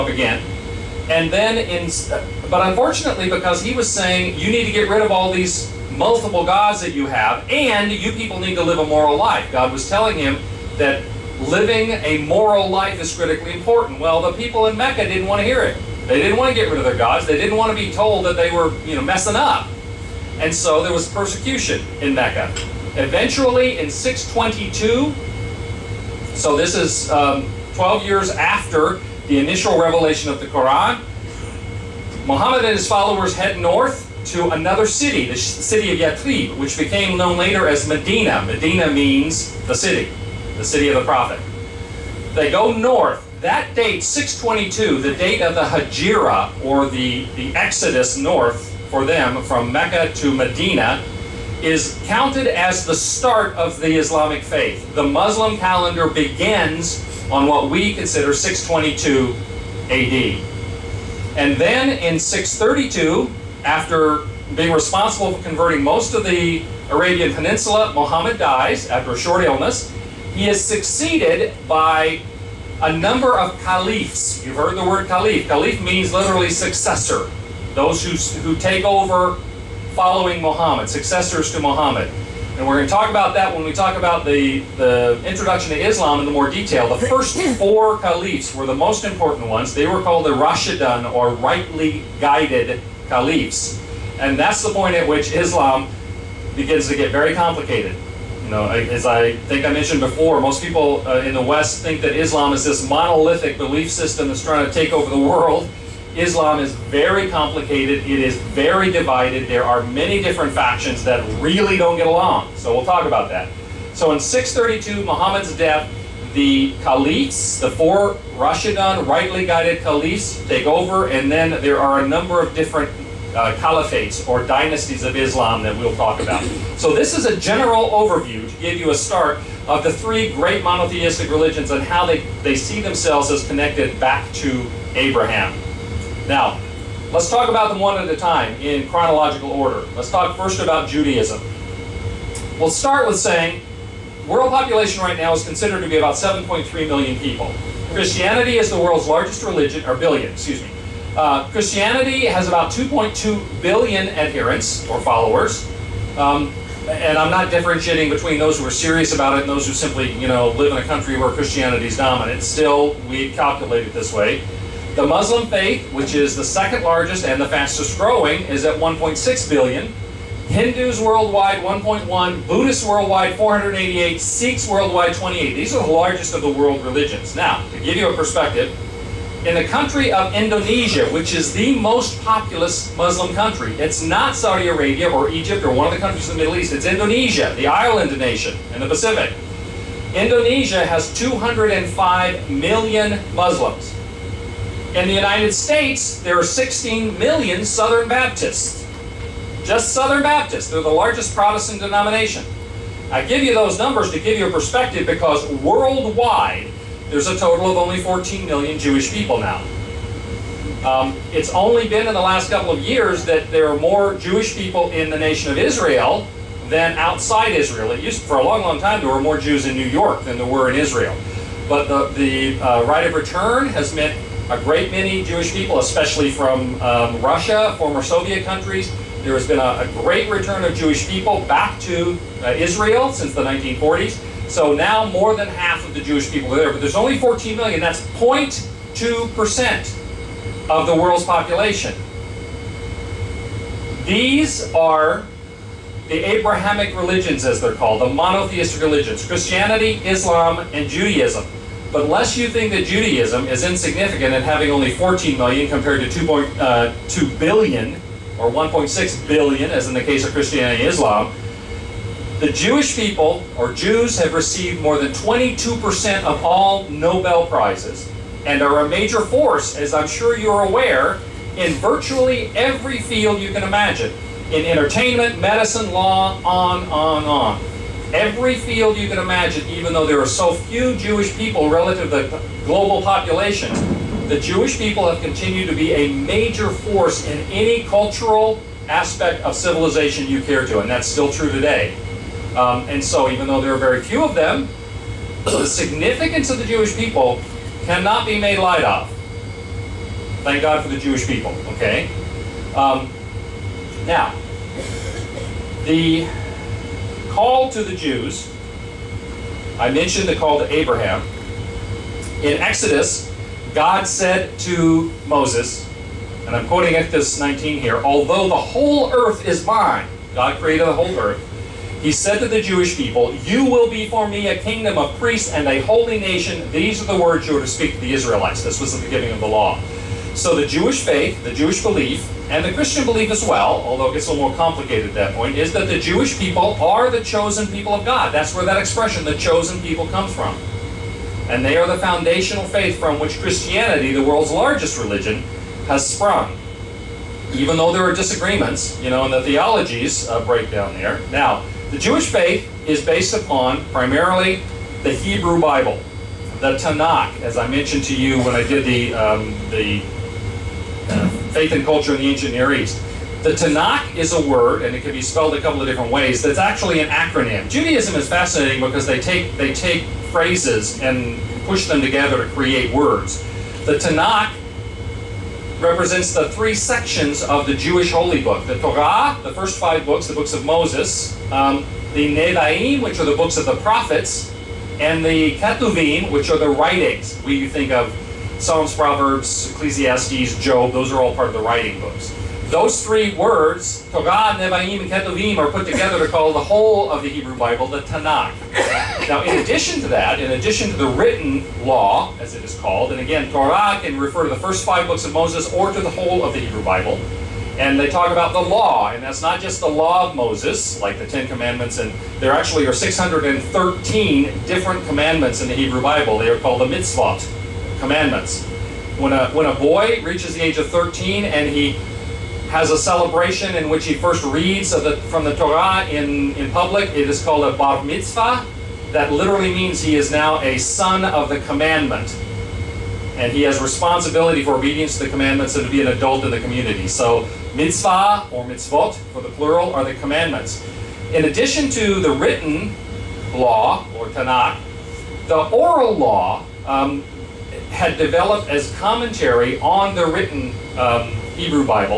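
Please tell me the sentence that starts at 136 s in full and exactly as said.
Now, let's talk about them one at a time in chronological order.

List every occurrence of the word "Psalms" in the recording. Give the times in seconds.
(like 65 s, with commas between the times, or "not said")
388 s.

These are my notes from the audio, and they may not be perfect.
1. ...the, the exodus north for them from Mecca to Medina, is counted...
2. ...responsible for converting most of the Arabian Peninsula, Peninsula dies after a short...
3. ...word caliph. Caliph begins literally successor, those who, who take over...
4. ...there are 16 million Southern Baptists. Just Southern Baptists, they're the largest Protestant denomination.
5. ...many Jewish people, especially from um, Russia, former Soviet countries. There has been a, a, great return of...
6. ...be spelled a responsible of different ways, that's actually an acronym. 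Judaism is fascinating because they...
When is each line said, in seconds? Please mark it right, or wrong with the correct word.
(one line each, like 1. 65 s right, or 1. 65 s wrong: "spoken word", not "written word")
1. 46 s right
2. 64 s wrong: "Muhammad", not "Peninsula"
3. 74 s wrong: "means", not "begins"
4. 196 s right
5. 224 s right
6. 365 s wrong: "couple", not "responsible".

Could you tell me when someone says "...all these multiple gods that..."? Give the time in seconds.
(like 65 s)
5 s.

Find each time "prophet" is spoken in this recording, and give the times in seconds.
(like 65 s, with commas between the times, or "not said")
41 s, 383 s.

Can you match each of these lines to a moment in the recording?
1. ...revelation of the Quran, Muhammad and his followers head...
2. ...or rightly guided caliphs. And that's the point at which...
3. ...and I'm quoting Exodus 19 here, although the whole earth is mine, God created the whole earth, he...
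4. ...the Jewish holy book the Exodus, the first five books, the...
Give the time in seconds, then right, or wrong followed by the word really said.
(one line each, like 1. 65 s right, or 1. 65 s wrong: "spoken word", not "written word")
1. 29 s right
2. 91 s right
3. 316 s right
4. 377 s wrong: "Torah", not "Exodus".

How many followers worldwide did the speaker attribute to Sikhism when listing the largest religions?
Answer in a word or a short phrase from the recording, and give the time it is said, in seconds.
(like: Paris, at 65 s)
28 million, at 174 s.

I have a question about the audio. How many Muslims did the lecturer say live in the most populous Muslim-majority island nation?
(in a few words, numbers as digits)
205 million.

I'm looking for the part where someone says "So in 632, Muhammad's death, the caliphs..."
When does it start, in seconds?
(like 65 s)
113 s.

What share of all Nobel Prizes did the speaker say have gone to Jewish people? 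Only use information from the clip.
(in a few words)
more than 22%.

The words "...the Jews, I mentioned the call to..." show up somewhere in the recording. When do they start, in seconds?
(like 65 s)
307 s.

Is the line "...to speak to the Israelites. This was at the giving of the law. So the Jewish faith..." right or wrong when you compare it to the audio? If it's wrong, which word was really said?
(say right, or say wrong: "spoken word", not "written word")
right.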